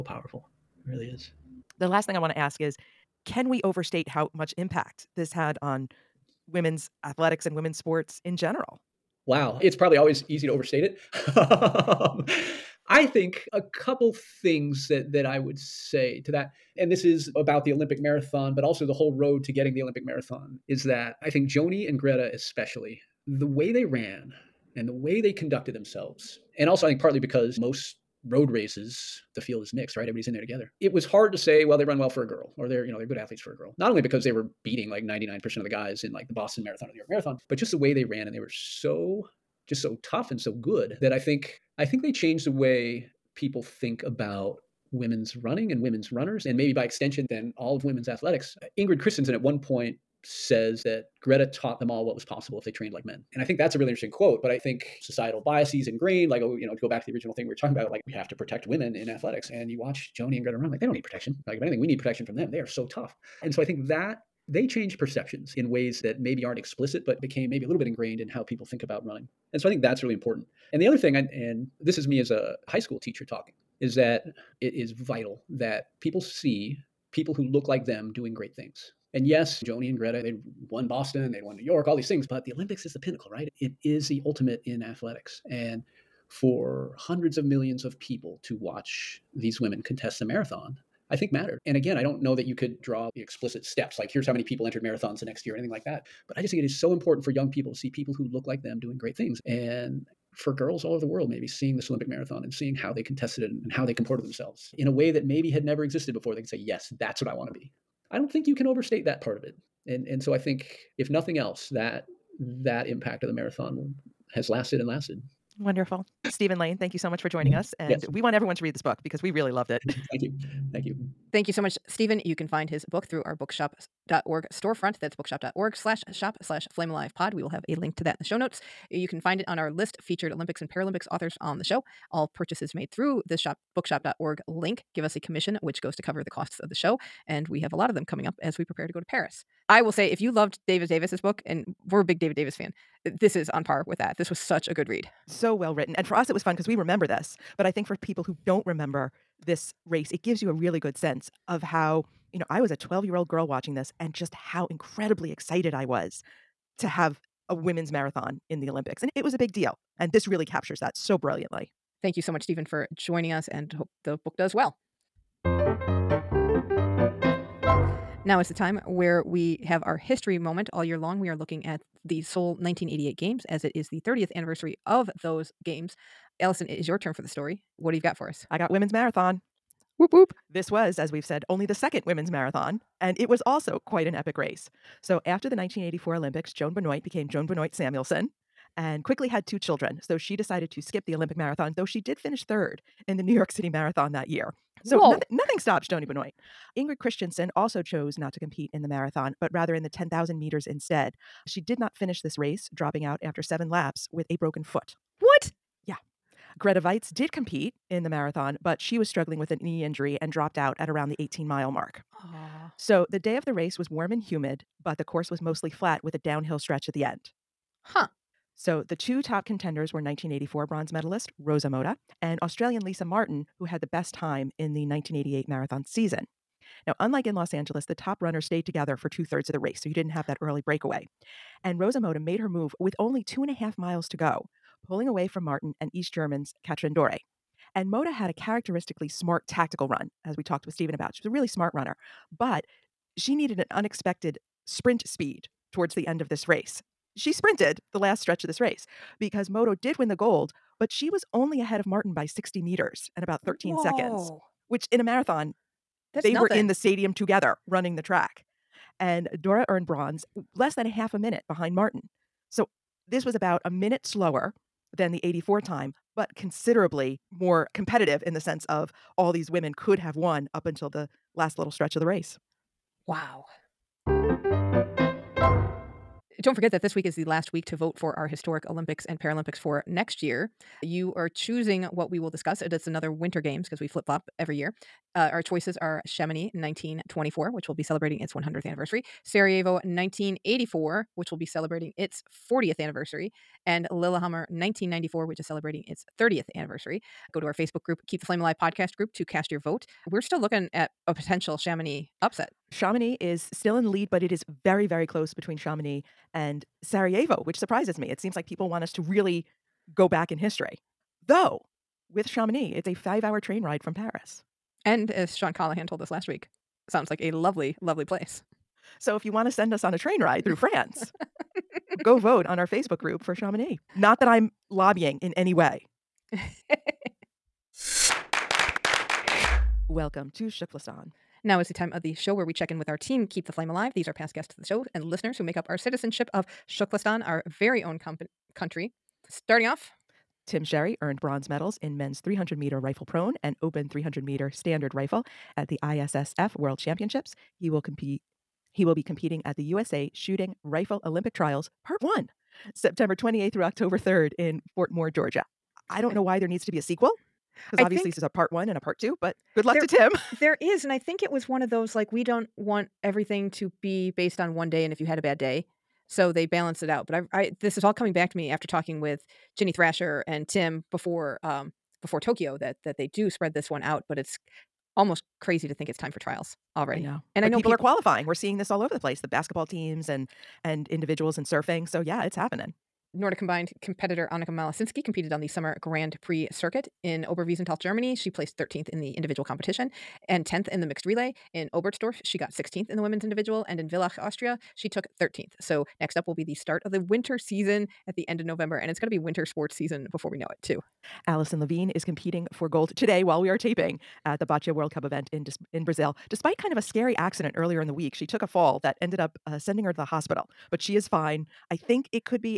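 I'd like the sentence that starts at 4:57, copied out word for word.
Go to our Facebook group, Keep the Flame Alive podcast group to cast your vote.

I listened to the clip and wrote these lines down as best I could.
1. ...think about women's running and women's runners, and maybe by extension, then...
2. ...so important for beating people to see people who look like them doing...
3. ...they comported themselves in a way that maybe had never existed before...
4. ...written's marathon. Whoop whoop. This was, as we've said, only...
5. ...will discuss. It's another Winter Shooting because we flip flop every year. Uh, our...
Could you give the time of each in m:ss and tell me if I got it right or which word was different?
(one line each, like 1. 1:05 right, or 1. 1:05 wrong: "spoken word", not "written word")
1. 0:43 right
2. 1:36 wrong: "young", not "beating"
3. 1:43 right
4. 2:58 wrong: "women", not "written"
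5. 4:42 wrong: "Games", not "Shooting".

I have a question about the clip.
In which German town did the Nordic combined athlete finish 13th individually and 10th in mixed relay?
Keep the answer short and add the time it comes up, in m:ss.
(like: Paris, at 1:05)
Oberwiesenthal, at 6:27.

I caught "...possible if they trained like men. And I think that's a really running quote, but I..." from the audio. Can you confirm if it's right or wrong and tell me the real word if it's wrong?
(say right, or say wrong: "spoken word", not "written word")
wrong: "interesting", not "running".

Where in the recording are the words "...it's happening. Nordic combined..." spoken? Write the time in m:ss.
6:22.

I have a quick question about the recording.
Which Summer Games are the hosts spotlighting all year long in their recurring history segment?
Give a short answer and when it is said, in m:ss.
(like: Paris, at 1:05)
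Seoul 1988, at 2:52.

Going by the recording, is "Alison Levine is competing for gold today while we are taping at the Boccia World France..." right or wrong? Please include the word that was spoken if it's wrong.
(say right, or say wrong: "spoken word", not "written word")
wrong: "Cup", not "France".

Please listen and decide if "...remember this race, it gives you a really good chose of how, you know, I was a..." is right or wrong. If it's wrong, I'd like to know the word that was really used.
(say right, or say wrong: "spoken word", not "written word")
wrong: "sense", not "chose".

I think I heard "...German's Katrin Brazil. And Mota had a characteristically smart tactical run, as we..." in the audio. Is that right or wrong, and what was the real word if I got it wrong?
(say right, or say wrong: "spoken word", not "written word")
wrong: "Dörre", not "Brazil".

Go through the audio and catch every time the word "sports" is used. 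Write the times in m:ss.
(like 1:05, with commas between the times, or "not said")
0:07, 6:39.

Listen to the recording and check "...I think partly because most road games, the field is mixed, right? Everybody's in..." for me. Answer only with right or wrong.
wrong.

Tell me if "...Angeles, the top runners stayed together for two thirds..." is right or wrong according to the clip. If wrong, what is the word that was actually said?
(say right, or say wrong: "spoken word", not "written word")
right.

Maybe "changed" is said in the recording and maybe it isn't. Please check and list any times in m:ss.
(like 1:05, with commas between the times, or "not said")
0:42, 1:04.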